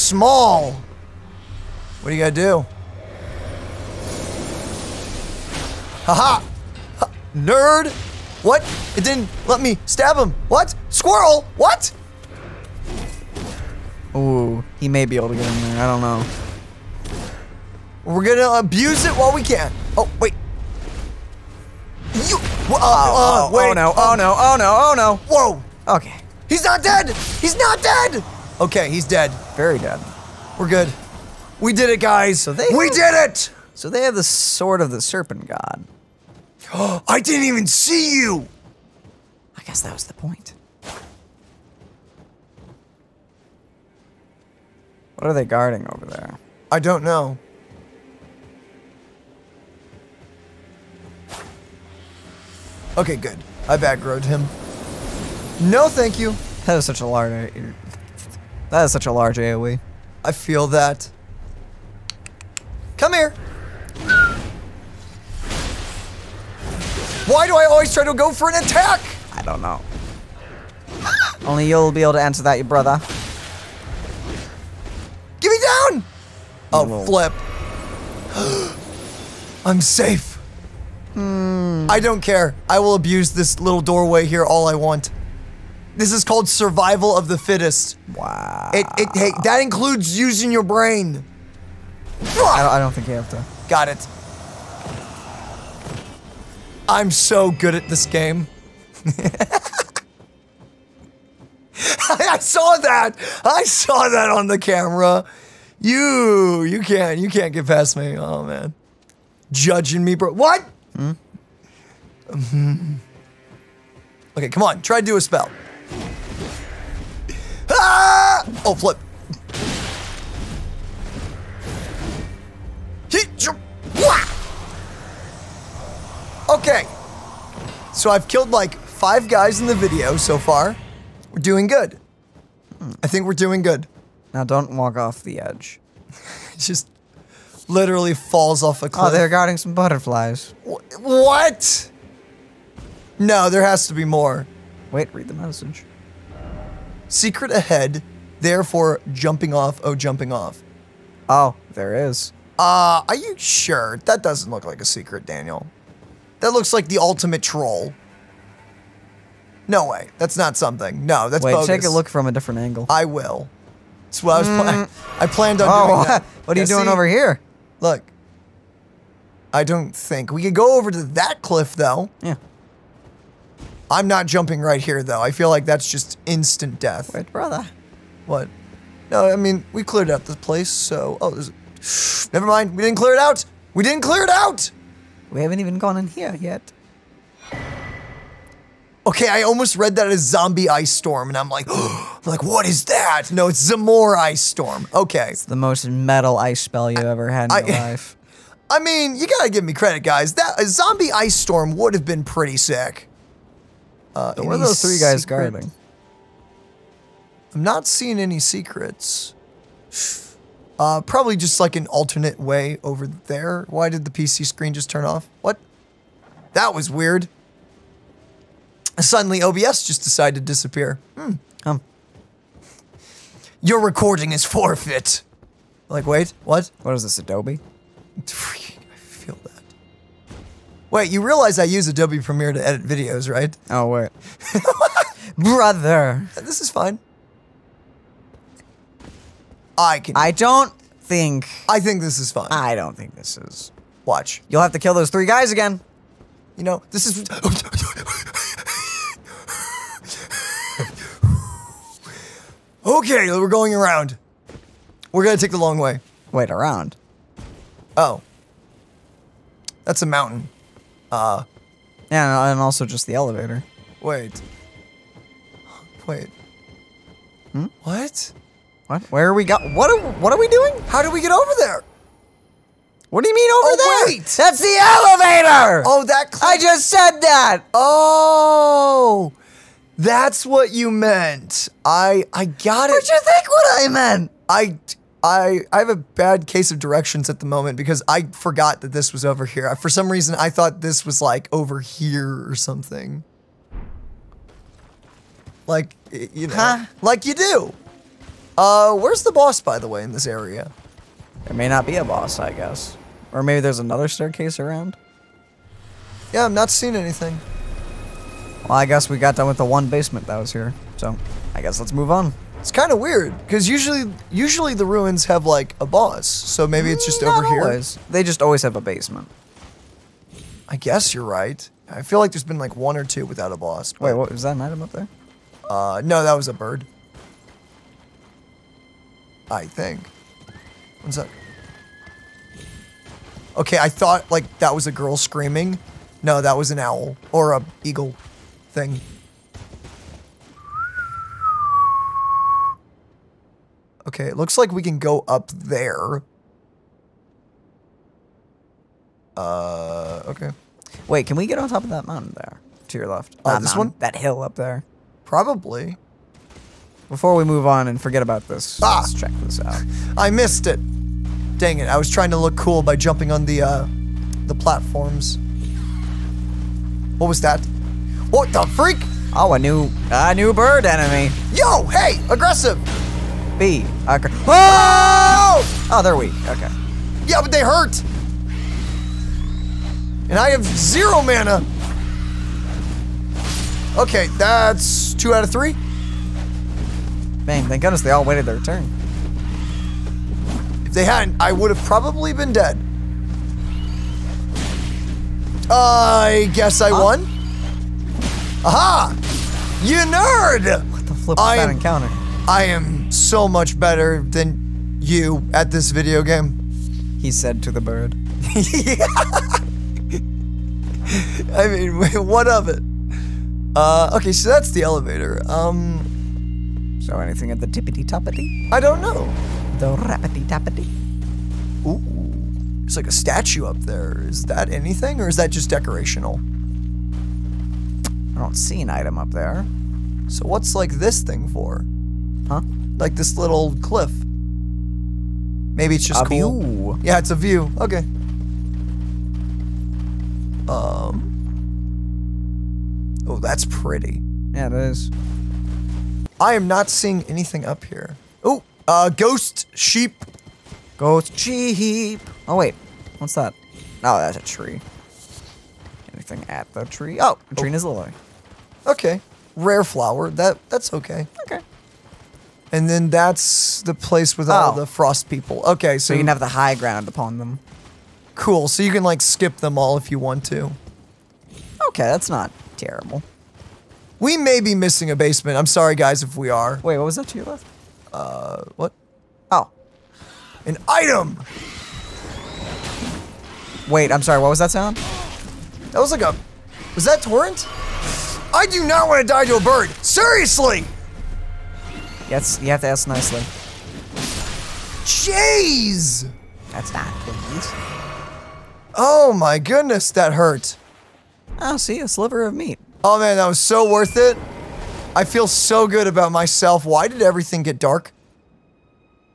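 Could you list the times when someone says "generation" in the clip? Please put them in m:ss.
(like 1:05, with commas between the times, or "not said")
not said.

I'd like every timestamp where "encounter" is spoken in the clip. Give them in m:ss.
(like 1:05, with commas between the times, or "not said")
6:41.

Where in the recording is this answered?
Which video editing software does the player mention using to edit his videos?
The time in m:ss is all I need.
3:51.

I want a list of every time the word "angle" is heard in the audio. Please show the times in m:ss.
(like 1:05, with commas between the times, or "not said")
2:42.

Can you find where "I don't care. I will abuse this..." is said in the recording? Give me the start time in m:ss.
1:21.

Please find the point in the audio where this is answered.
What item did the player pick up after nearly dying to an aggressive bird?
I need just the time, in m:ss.
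8:22.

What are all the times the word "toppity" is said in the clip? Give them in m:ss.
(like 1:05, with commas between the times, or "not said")
6:58.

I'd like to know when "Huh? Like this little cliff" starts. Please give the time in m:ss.
7:12.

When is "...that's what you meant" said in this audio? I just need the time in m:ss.
4:39.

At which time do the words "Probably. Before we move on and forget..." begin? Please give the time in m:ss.
5:55.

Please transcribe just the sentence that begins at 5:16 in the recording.
So maybe it's just mm, Not over always.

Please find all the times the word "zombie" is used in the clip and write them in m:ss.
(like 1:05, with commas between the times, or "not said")
3:10, 3:20.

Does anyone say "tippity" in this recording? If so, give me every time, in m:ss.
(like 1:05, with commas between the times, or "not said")
6:57.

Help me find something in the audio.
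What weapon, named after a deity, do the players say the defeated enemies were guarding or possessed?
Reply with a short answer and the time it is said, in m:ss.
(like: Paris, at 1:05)
Sword of the serpent god, at 0:34.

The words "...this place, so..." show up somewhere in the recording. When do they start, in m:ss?
3:00.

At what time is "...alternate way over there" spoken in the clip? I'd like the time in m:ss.
3:31.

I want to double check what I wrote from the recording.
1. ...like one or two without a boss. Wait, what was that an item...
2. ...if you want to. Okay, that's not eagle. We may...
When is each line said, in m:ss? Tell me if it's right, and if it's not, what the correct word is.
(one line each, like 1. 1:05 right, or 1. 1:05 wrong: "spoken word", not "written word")
1. 5:22 right
2. 7:49 wrong: "terrible", not "eagle".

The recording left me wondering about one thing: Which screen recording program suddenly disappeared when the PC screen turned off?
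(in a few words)
OBS.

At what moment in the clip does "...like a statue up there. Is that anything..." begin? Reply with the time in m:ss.
7:02.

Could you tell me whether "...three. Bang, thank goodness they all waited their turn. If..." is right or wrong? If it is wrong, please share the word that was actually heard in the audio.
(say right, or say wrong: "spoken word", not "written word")
right.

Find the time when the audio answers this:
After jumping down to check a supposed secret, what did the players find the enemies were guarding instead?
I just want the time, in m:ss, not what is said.
2:19.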